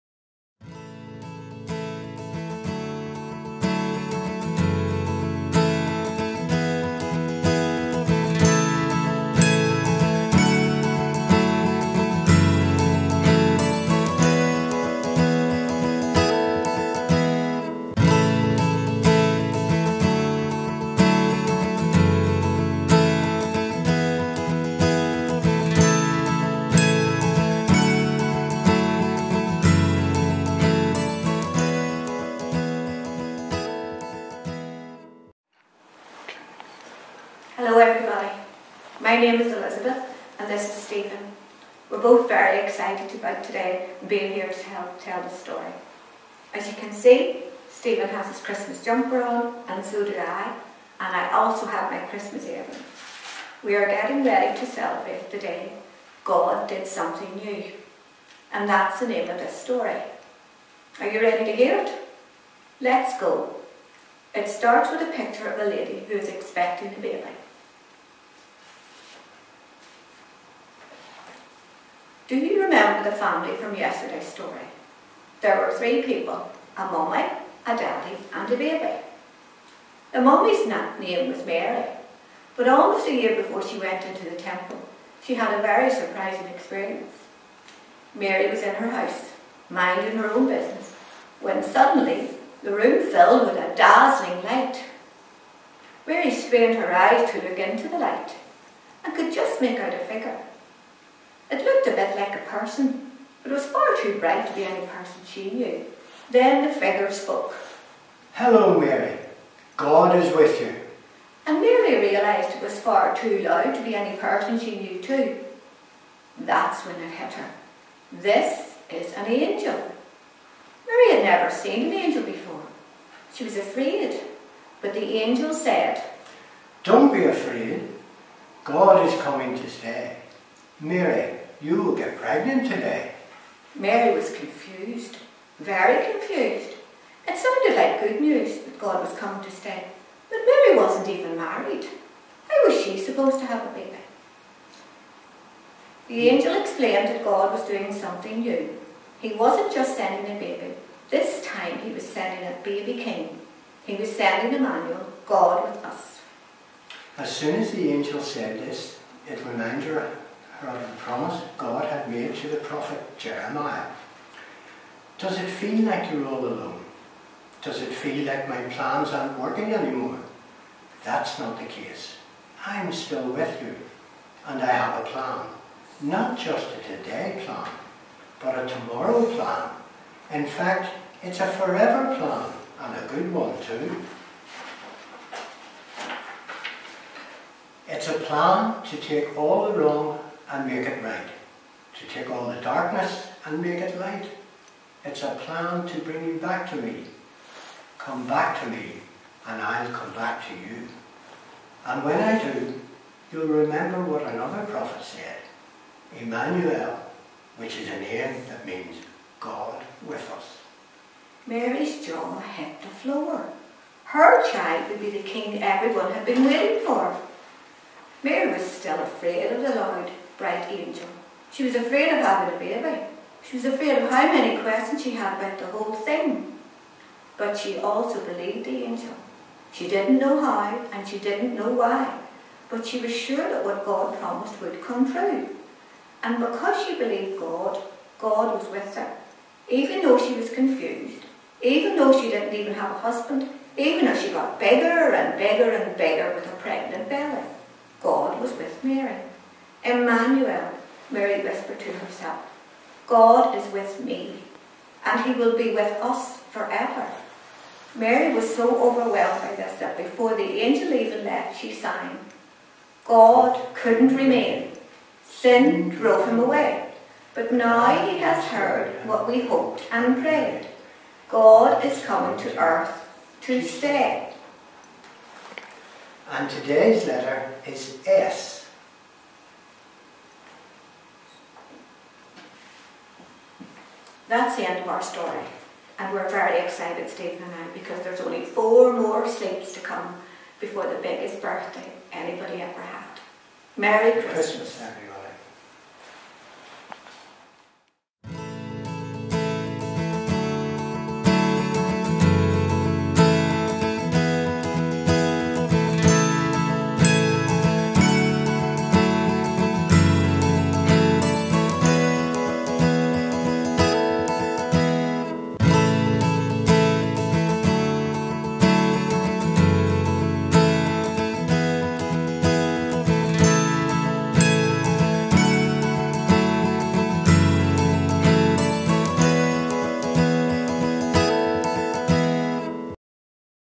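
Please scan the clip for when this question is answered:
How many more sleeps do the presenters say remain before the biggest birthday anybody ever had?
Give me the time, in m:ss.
4:48.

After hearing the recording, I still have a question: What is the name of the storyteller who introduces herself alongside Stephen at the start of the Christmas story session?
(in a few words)
Elizabeth.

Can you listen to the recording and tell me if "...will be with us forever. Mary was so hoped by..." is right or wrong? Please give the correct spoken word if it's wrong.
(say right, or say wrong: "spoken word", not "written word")
wrong: "overwhelmed", not "hoped".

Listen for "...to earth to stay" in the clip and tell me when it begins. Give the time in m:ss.
4:32.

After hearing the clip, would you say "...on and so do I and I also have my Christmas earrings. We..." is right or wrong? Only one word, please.
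right.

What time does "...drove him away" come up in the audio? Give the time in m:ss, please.
4:25.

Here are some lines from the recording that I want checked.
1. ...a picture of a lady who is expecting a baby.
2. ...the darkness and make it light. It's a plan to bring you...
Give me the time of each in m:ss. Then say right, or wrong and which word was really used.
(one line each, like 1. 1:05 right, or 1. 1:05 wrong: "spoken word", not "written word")
1. 1:05 right
2. 3:12 right.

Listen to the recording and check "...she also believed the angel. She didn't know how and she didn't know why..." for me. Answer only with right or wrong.
right.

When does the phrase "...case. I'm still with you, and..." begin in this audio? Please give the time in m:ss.
2:51.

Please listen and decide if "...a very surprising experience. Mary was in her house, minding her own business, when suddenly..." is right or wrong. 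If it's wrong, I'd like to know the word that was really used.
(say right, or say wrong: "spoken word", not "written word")
right.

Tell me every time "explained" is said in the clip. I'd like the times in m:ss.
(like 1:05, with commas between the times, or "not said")
2:26.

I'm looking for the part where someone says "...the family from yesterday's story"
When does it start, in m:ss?
1:13.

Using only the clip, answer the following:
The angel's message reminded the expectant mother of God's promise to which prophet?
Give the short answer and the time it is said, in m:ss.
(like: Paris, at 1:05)
Jeremiah, at 2:43.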